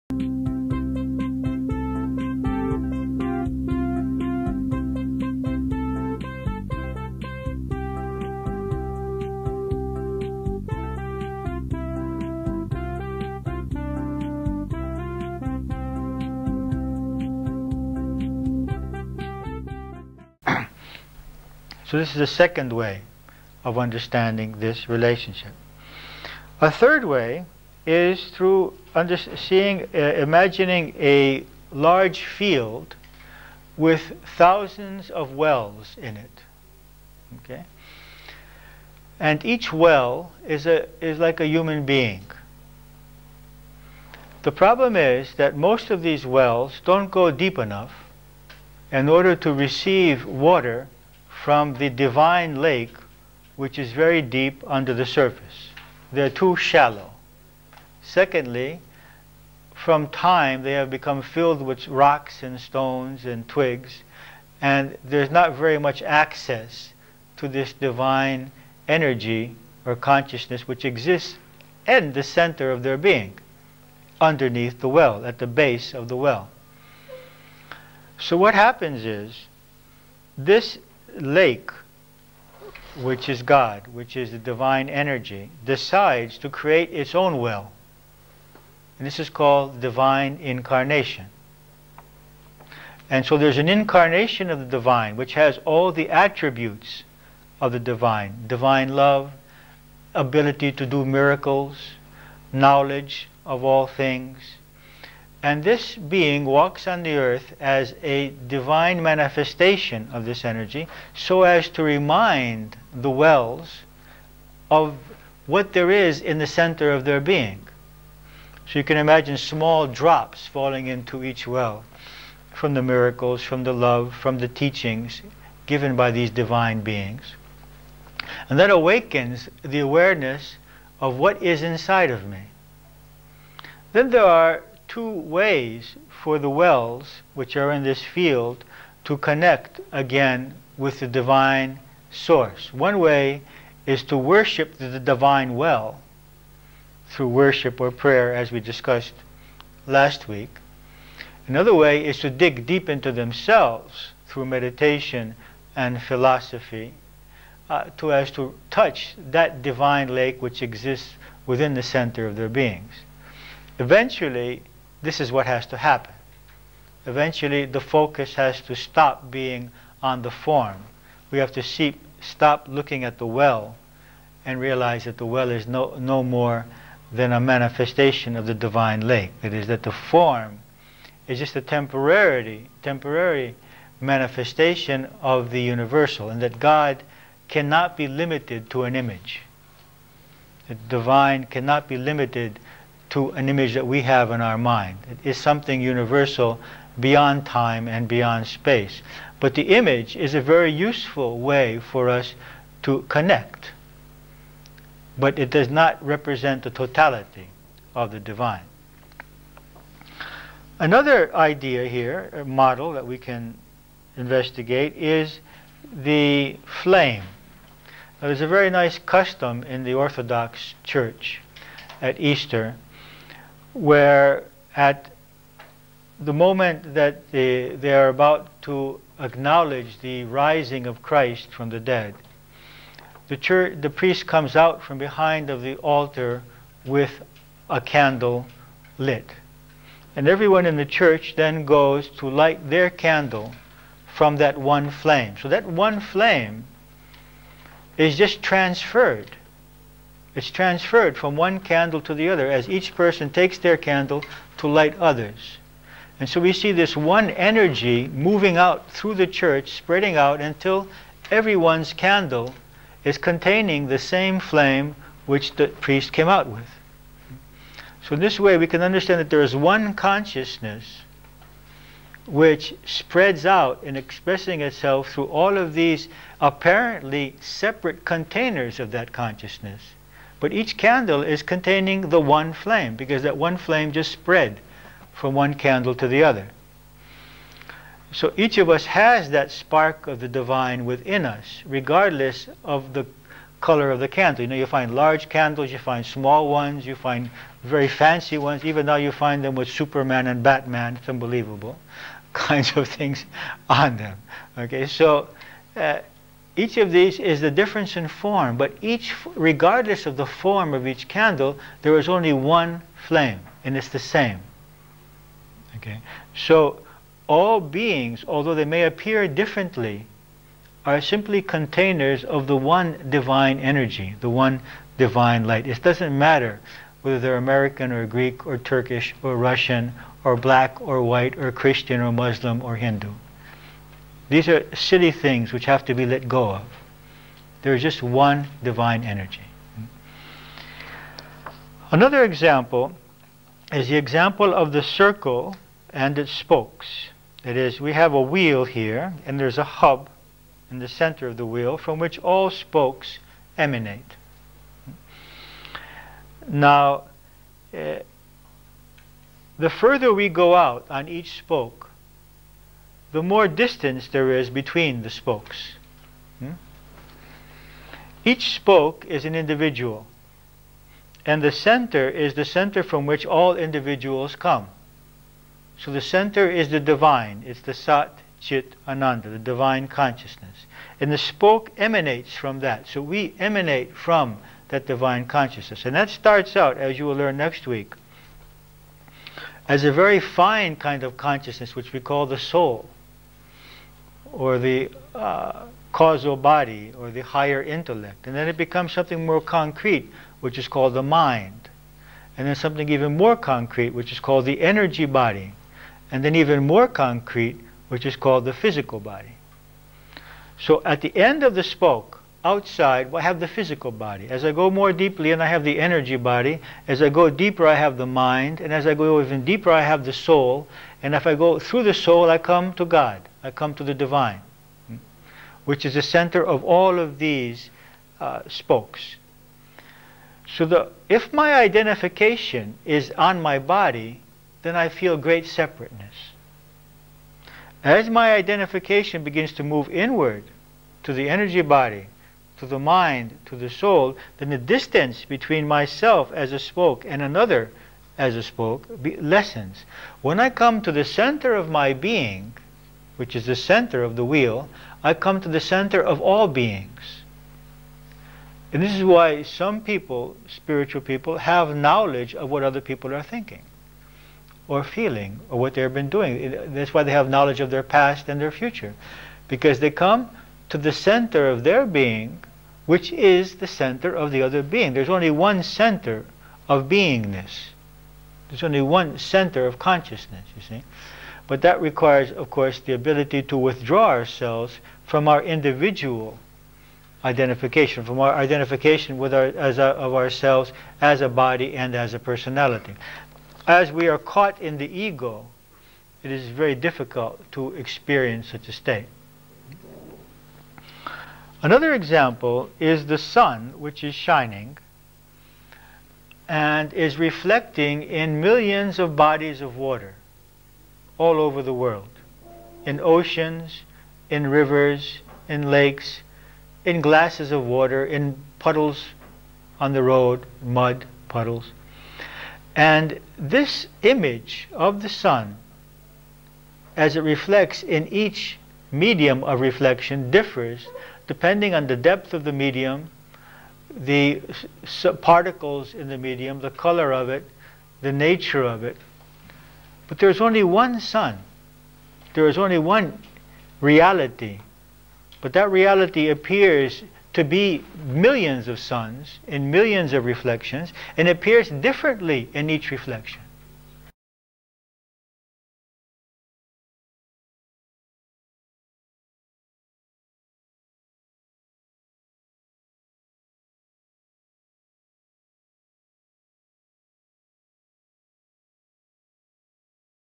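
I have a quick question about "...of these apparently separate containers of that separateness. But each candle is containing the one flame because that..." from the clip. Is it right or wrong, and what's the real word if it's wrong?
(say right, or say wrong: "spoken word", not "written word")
wrong: "consciousness", not "separateness".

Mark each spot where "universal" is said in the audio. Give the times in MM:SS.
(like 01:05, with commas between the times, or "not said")
03:05, 03:15.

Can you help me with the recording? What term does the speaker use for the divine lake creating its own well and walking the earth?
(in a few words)
Divine incarnation.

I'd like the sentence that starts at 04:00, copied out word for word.
And everyone in the church then goes to light their candle from that one flame.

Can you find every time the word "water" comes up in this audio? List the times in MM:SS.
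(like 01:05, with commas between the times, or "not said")
00:50, 08:29, 08:37.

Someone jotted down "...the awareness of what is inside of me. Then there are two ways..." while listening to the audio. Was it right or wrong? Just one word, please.
right.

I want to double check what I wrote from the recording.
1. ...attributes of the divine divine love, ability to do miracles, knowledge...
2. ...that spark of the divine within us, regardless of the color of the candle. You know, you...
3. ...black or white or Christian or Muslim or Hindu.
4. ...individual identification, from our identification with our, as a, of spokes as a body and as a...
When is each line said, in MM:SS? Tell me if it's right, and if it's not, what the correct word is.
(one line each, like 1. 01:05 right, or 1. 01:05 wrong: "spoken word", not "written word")
1. 01:36 right
2. 04:49 right
3. 05:30 right
4. 08:05 wrong: "ourselves", not "spokes".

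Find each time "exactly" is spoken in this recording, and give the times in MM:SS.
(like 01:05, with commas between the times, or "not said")
not said.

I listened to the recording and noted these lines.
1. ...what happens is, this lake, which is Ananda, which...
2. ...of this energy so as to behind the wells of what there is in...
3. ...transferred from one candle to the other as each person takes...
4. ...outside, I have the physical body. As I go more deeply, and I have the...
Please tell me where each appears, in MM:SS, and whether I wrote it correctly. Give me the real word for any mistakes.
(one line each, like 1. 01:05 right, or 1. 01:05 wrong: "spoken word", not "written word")
1. 01:18 wrong: "God", not "Ananda"
2. 01:50 wrong: "remind", not "behind"
3. 04:10 right
4. 06:52 right.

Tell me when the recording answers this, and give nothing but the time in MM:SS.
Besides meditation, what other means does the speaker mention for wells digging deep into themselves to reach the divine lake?
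02:36.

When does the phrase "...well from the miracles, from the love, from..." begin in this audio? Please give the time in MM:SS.
02:01.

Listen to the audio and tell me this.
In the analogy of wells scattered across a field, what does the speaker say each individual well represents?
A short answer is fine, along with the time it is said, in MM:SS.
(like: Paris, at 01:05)
A human being, at 00:41.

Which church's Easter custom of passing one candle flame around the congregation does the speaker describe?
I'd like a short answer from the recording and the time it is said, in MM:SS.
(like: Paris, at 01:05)
The Orthodox Church, at 03:39.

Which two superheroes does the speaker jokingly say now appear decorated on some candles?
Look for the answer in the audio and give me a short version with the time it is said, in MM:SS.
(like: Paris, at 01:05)
Superman and Batman, at 04:59.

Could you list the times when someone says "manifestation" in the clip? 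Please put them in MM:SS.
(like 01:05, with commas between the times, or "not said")
01:49, 02:57, 03:03.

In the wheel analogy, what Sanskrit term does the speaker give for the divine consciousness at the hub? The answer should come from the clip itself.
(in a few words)
Sat Chit Ananda.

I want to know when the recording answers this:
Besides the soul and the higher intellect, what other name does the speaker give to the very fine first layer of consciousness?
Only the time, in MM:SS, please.
06:35.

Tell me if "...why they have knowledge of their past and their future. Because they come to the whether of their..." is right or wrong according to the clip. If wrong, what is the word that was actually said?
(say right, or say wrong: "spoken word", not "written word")
wrong: "center", not "whether".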